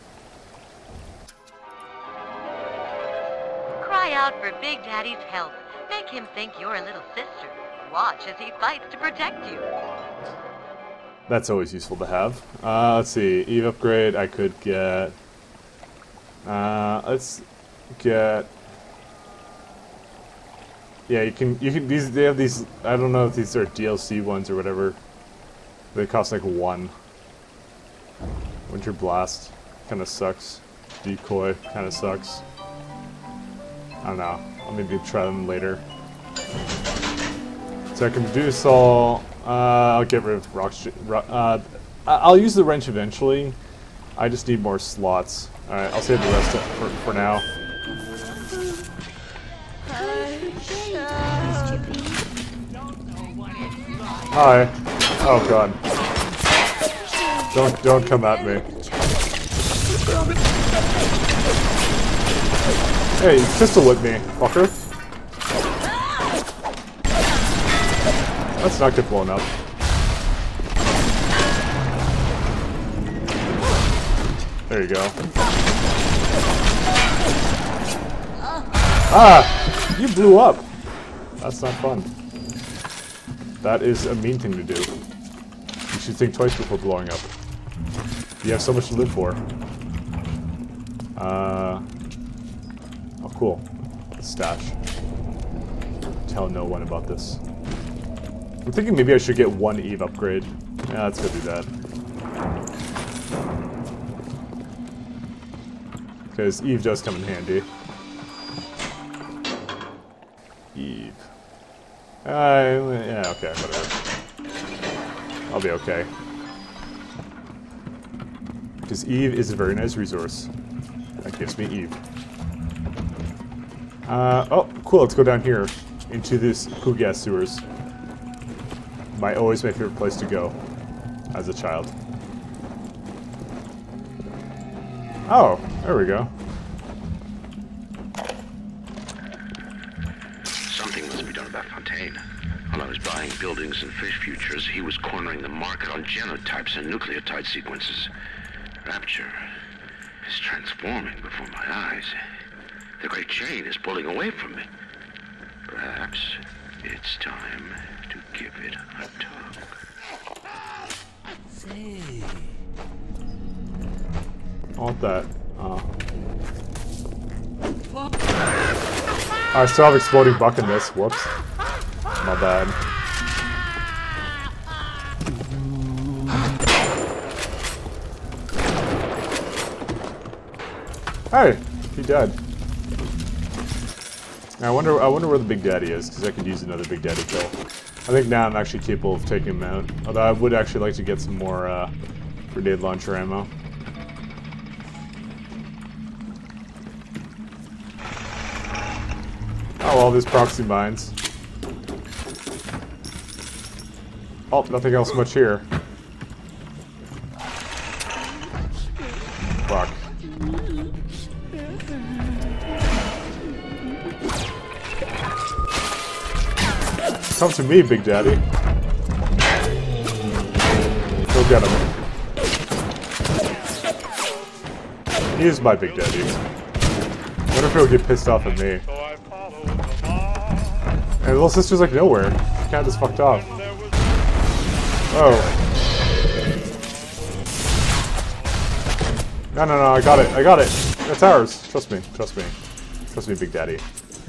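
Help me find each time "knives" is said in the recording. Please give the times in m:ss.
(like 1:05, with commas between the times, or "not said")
not said.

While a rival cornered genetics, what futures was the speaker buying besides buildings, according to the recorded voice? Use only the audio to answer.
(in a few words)
fish futures.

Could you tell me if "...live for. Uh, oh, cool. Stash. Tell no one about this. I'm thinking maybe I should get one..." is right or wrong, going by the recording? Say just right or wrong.
right.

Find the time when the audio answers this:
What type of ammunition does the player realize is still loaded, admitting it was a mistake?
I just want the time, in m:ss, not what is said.
2:49.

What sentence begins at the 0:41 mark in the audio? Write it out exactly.
Uh, I'll use the wrench eventually.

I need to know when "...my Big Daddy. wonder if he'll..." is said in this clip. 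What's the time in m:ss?
3:45.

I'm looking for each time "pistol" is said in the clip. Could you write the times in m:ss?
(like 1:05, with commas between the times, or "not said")
1:03.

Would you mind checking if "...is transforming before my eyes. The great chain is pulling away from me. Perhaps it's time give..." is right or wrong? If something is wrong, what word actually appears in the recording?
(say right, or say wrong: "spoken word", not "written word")
right.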